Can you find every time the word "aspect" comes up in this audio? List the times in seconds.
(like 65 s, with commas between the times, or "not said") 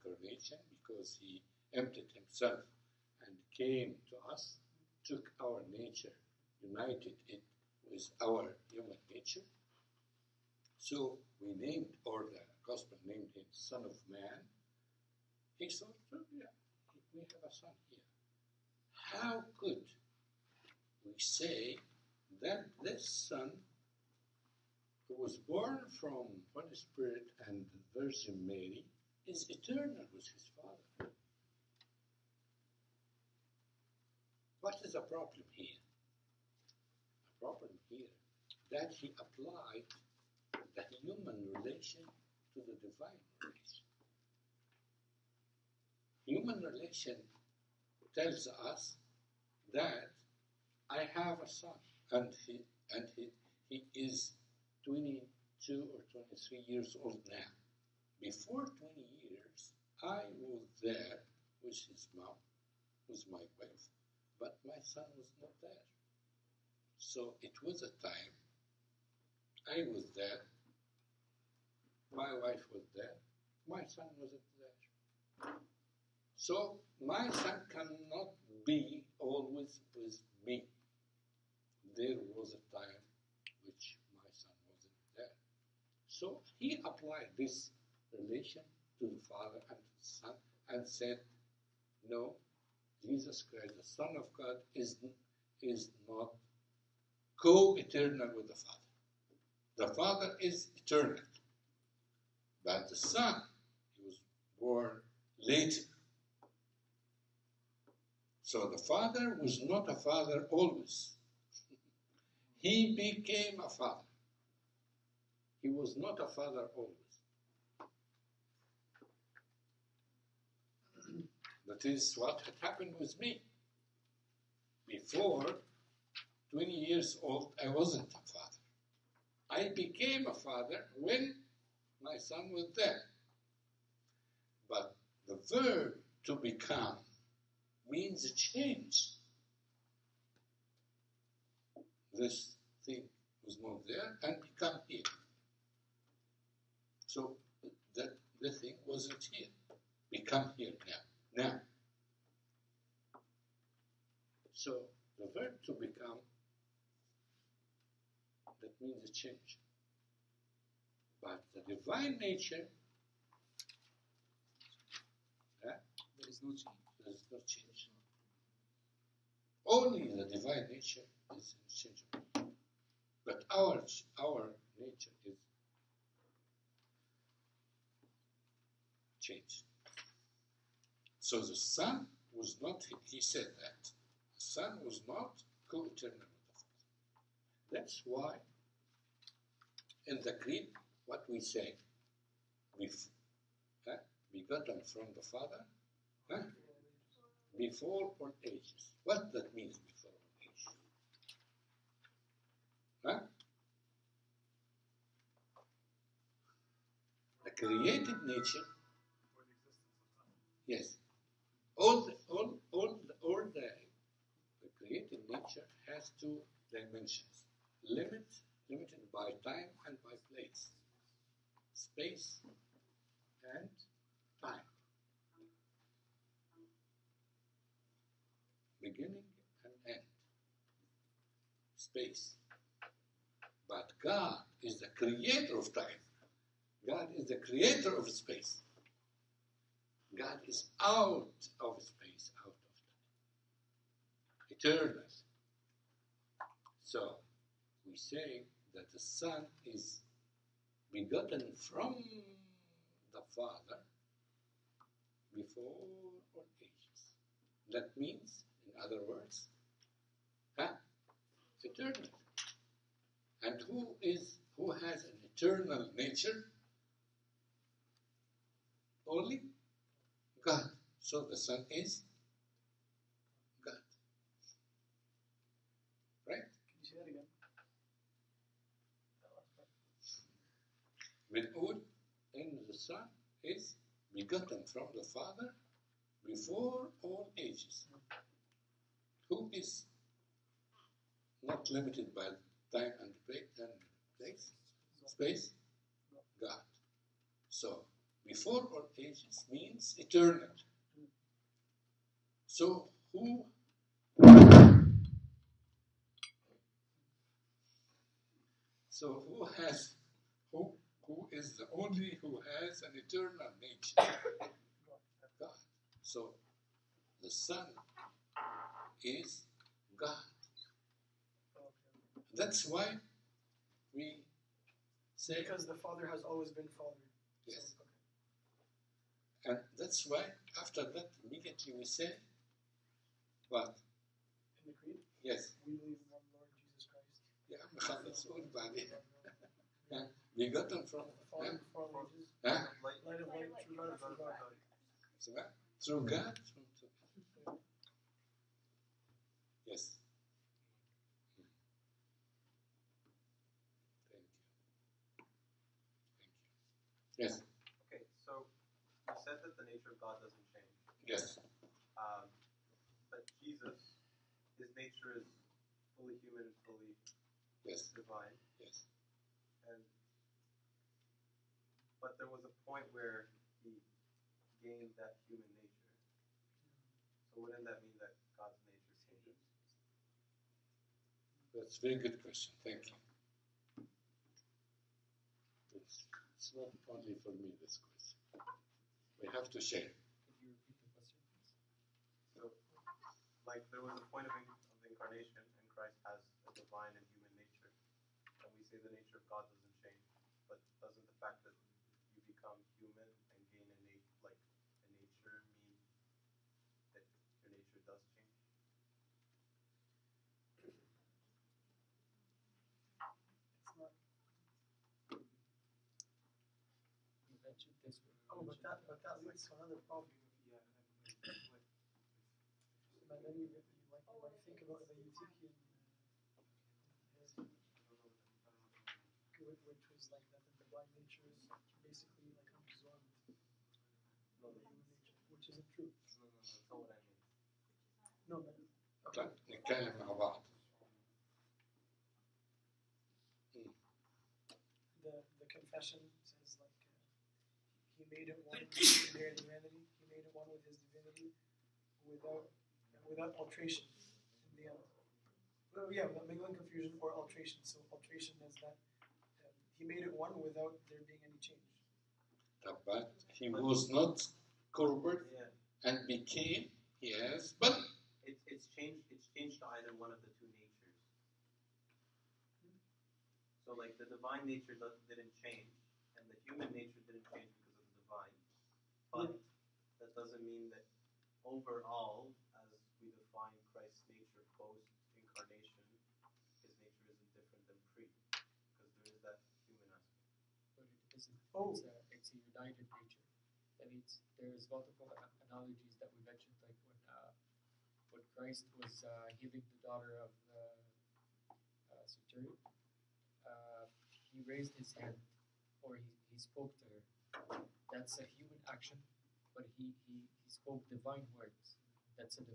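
489 s.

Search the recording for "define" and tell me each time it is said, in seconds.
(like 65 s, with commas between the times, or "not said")
483 s.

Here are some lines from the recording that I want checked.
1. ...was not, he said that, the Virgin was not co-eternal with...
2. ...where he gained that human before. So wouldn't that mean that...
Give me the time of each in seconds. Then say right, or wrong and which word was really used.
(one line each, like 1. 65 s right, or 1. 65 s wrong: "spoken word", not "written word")
1. 182 s wrong: "Son", not "Virgin"
2. 372 s wrong: "nature", not "before".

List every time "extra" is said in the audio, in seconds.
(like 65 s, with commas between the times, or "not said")
not said.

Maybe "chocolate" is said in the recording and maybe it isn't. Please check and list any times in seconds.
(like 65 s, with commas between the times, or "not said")
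not said.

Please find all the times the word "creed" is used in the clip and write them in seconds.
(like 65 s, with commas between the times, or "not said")
190 s, 334 s.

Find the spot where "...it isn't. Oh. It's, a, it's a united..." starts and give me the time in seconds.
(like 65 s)
490 s.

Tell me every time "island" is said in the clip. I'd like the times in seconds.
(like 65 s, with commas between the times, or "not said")
not said.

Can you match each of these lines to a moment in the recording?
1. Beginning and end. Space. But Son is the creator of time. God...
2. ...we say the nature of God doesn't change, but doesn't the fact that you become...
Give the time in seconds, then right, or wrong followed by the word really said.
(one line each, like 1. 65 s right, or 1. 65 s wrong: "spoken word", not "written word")
1. 228 s wrong: "God", not "Son"
2. 398 s right.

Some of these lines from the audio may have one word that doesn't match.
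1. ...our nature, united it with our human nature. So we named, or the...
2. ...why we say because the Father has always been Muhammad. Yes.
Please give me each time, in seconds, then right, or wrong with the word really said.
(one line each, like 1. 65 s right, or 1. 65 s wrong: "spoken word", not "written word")
1. 5 s right
2. 322 s wrong: "Father", not "Muhammad".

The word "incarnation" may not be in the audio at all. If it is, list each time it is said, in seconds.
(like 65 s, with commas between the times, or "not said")
394 s, 485 s.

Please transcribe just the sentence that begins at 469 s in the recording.
It's changed to either one of the two natures.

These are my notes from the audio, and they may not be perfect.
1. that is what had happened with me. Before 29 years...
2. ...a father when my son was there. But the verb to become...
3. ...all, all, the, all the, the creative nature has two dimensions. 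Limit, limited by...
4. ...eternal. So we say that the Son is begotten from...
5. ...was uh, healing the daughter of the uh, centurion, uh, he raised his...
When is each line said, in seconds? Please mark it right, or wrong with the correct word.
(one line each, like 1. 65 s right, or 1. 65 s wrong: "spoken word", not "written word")
1. 121 s wrong: "20", not "29"
2. 130 s right
3. 212 s right
4. 244 s right
5. 498 s right.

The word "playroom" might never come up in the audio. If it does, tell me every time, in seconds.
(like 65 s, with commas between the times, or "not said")
not said.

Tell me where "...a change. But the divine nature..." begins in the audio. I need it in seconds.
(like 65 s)
159 s.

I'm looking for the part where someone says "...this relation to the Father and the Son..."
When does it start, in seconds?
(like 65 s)
87 s.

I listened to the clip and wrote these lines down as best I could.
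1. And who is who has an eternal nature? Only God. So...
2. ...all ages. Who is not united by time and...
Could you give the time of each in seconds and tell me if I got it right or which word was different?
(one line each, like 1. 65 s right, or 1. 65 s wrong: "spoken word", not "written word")
1. 263 s right
2. 287 s wrong: "limited", not "united".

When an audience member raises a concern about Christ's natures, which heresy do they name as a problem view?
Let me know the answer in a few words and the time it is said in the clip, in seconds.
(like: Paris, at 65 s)
Eutychian, at 424 s.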